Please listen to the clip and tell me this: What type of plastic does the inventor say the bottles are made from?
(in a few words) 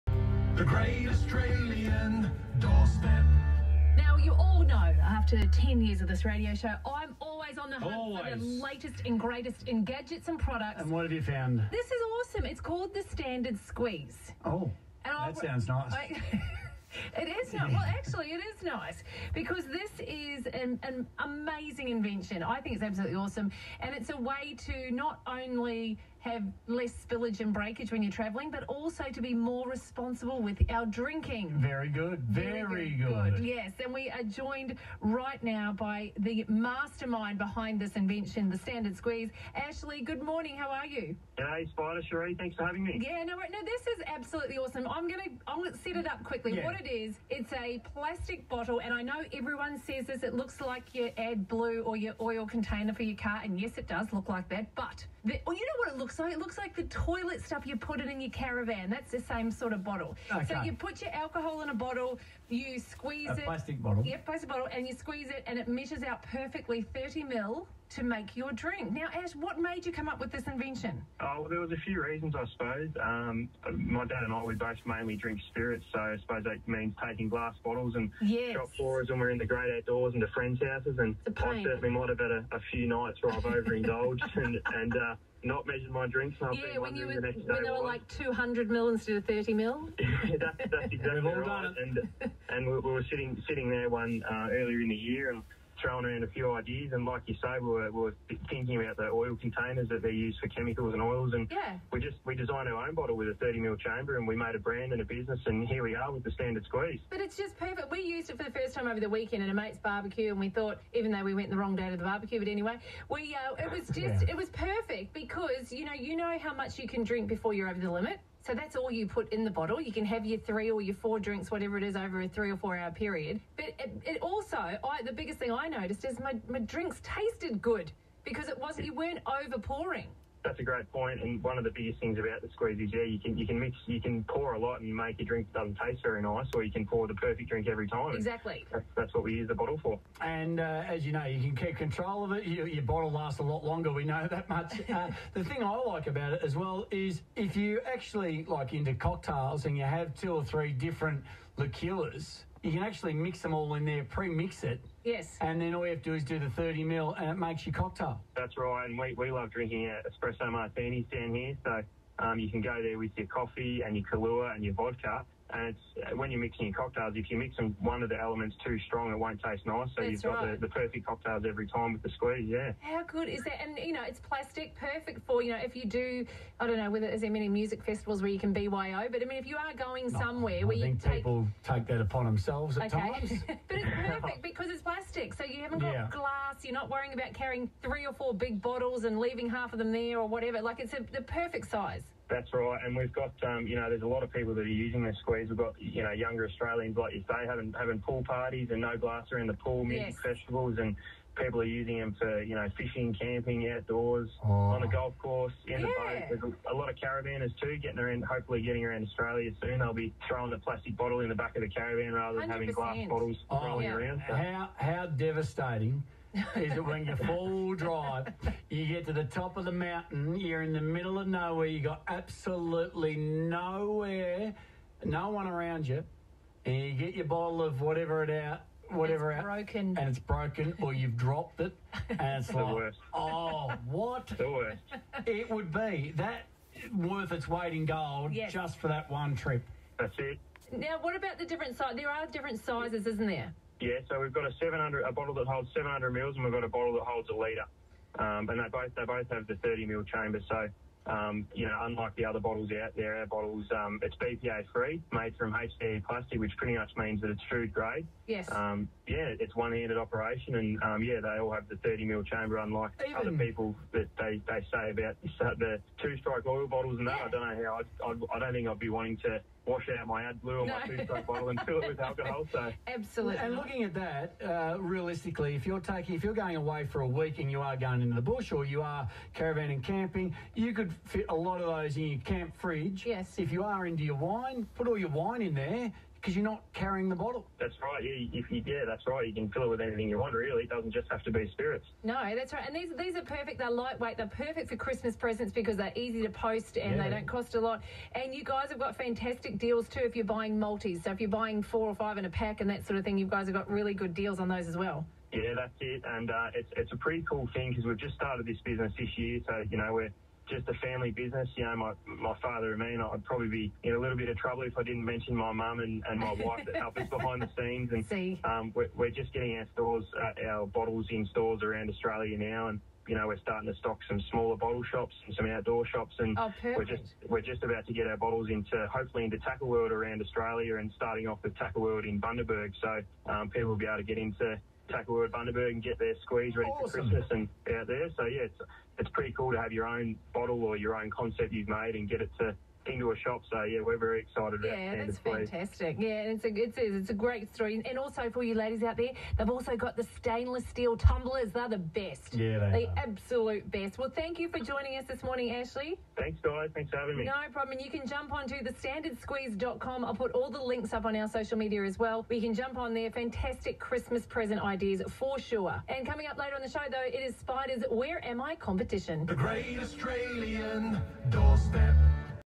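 HDPE.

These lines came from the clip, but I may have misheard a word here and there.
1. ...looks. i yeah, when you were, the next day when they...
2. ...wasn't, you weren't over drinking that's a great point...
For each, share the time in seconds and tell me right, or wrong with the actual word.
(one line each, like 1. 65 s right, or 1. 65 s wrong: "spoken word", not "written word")
1. 86 s wrong: "drinks", not "looks"
2. 128 s wrong: "pouring", not "drinking".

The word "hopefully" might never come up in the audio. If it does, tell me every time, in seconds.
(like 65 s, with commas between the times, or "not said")
208 s, 328 s.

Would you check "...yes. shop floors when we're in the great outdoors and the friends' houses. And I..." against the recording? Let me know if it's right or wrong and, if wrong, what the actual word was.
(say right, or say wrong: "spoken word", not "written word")
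right.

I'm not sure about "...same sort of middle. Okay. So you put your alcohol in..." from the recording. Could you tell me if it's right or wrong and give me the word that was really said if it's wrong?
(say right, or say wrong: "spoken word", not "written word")
wrong: "bottle", not "middle".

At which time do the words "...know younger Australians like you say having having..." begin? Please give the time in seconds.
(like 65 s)
196 s.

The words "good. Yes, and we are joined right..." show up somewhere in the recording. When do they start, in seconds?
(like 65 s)
33 s.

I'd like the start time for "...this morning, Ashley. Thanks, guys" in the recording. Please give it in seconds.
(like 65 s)
355 s.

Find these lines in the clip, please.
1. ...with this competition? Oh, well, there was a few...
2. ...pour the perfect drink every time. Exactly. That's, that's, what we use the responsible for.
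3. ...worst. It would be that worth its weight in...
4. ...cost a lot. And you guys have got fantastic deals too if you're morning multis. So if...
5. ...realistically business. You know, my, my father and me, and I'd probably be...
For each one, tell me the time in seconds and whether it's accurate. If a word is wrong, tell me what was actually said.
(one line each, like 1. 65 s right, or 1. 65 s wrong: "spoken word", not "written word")
1. 70 s wrong: "invention", not "competition"
2. 136 s wrong: "bottle", not "responsible"
3. 234 s right
4. 297 s wrong: "buying", not "morning"
5. 310 s wrong: "family", not "realistically".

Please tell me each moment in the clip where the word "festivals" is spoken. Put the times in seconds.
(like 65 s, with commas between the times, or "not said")
177 s, 200 s.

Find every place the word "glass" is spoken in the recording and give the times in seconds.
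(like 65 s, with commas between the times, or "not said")
77 s, 186 s, 198 s, 212 s.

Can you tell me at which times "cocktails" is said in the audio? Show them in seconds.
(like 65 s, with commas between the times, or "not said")
148 s, 157 s, 166 s, 171 s.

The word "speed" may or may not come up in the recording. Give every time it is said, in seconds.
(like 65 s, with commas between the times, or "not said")
not said.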